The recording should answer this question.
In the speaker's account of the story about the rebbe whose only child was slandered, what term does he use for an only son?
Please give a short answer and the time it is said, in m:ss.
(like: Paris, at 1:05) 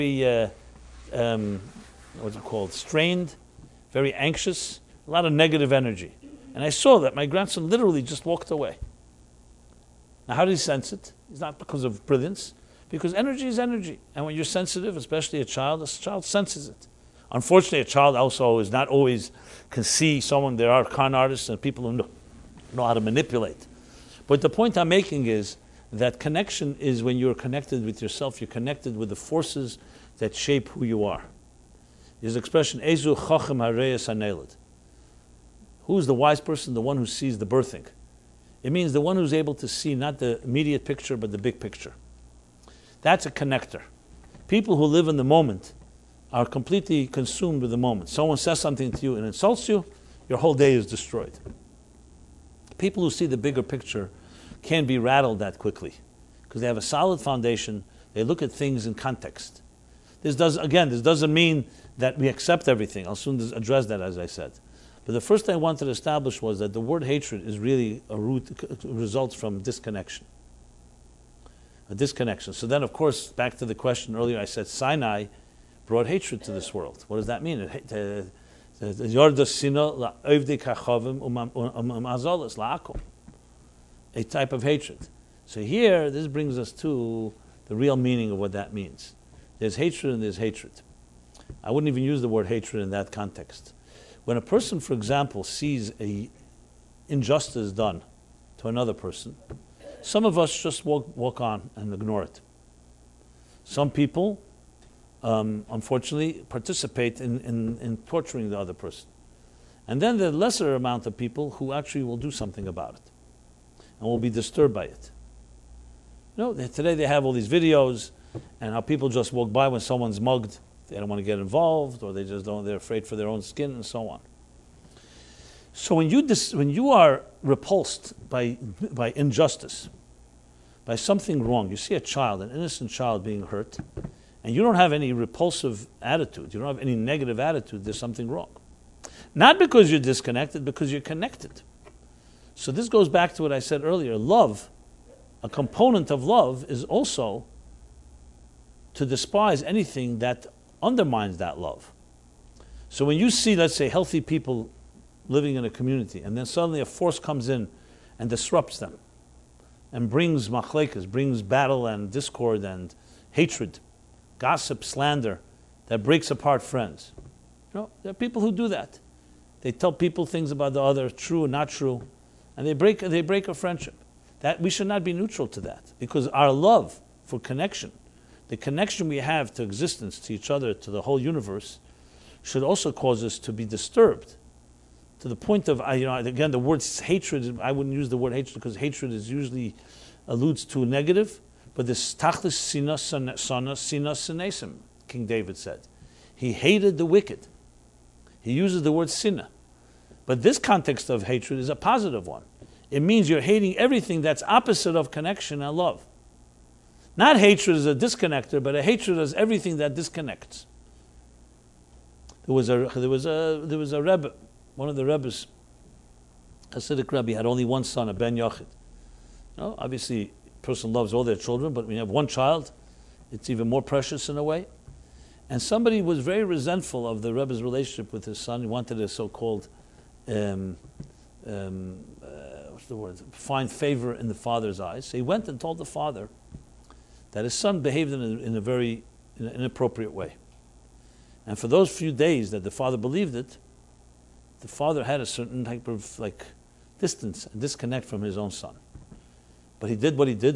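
ben Yochid, at 3:38.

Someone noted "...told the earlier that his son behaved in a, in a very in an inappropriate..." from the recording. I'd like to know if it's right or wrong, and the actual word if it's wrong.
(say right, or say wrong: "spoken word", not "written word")
wrong: "father", not "earlier".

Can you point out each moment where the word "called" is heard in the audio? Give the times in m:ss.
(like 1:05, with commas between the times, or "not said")
0:02, 3:49.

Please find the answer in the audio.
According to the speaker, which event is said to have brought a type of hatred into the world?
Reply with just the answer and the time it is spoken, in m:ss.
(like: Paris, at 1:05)
Sinai, at 1:14.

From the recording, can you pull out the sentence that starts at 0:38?
It means the one who's able to see not the immediate picture, but the big picture.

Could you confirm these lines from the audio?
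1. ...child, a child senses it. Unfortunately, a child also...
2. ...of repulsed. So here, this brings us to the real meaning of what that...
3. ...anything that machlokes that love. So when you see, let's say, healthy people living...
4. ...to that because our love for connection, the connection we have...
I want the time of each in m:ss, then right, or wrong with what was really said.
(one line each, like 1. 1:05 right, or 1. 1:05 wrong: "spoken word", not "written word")
1. 0:15 right
2. 1:24 wrong: "hatred", not "repulsed"
3. 2:29 wrong: "undermines", not "machlokes"
4. 2:55 right.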